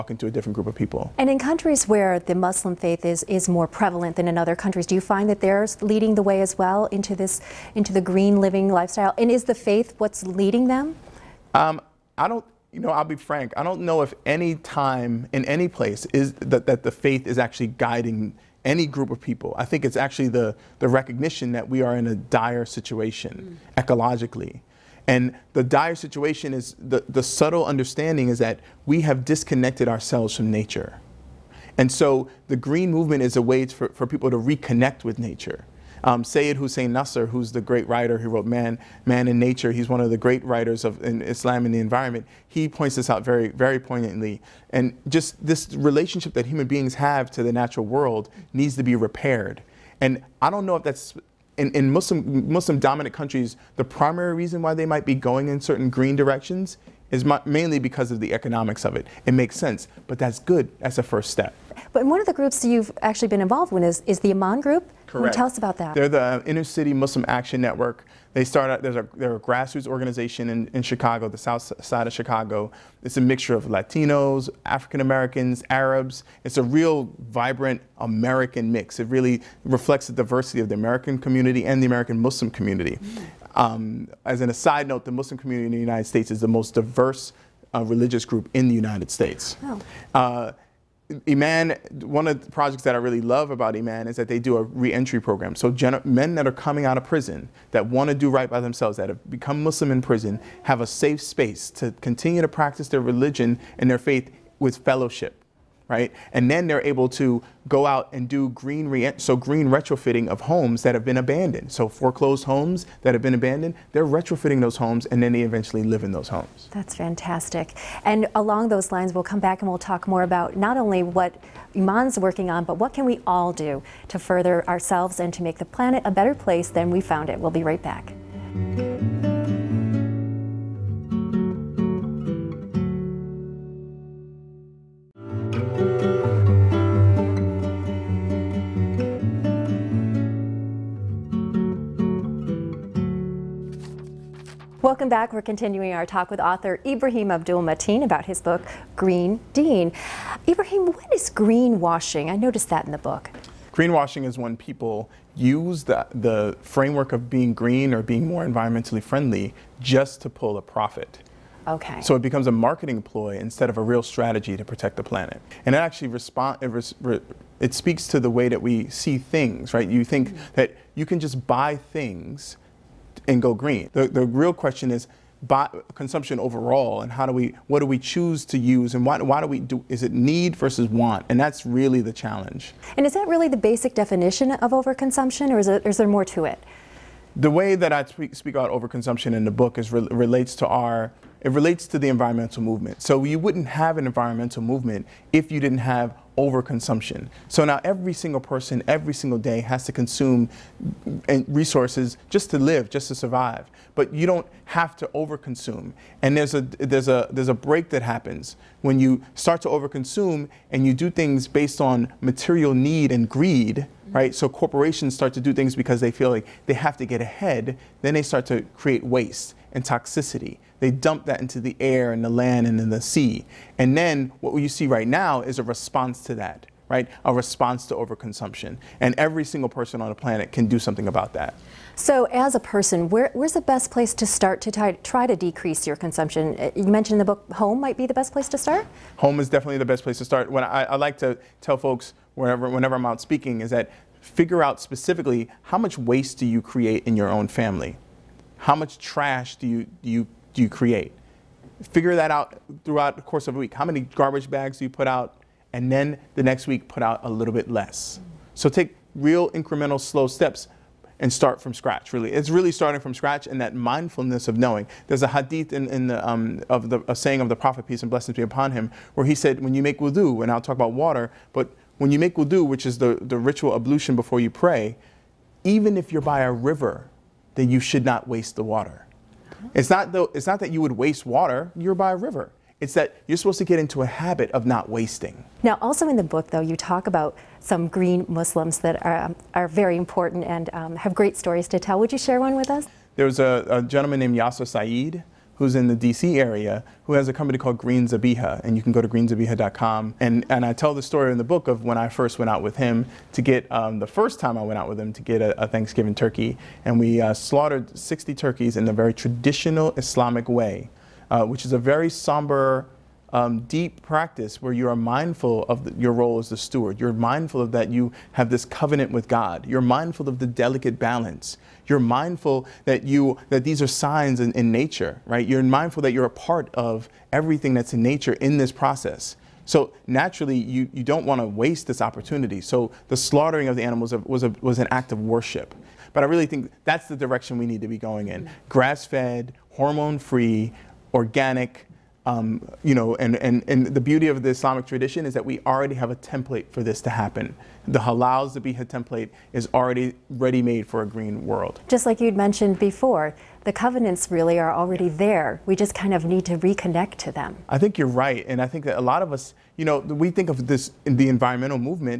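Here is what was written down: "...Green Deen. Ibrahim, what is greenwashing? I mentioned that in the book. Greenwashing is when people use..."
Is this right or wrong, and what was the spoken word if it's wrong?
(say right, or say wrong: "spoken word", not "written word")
wrong: "noticed", not "mentioned".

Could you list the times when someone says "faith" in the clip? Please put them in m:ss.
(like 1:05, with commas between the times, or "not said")
0:02, 0:09, 0:16, 1:43.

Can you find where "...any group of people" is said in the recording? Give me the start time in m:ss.
0:18.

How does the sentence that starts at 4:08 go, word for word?
How much trash do you, do you do you create?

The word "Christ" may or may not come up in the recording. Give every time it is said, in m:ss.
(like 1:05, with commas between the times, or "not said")
not said.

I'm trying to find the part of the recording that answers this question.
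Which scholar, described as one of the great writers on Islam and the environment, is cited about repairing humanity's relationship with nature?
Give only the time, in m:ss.
0:36.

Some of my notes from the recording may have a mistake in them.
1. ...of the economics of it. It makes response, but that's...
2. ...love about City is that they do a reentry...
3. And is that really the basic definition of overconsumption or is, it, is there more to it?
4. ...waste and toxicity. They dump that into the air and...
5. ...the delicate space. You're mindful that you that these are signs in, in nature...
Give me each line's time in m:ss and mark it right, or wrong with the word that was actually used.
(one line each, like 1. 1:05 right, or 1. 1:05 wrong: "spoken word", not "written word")
1. 0:58 wrong: "sense", not "response"
2. 1:33 wrong: "Iman", not "City"
3. 3:02 right
4. 3:39 right
5. 5:20 wrong: "balance", not "space".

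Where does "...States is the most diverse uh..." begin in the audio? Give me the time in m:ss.
1:26.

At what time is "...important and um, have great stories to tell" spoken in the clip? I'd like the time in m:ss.
4:49.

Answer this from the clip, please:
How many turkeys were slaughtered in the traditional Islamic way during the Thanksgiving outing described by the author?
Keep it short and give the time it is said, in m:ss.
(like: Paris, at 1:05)
60, at 5:07.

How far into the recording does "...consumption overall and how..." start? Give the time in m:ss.
2:55.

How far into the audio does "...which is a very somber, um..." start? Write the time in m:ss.
5:11.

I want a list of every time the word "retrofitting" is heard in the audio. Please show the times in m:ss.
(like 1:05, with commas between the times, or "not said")
1:49, 1:54.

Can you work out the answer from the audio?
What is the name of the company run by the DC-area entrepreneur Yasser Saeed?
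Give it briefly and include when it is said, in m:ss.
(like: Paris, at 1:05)
Green Zabiha, at 4:57.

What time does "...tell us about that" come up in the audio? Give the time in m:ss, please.
1:05.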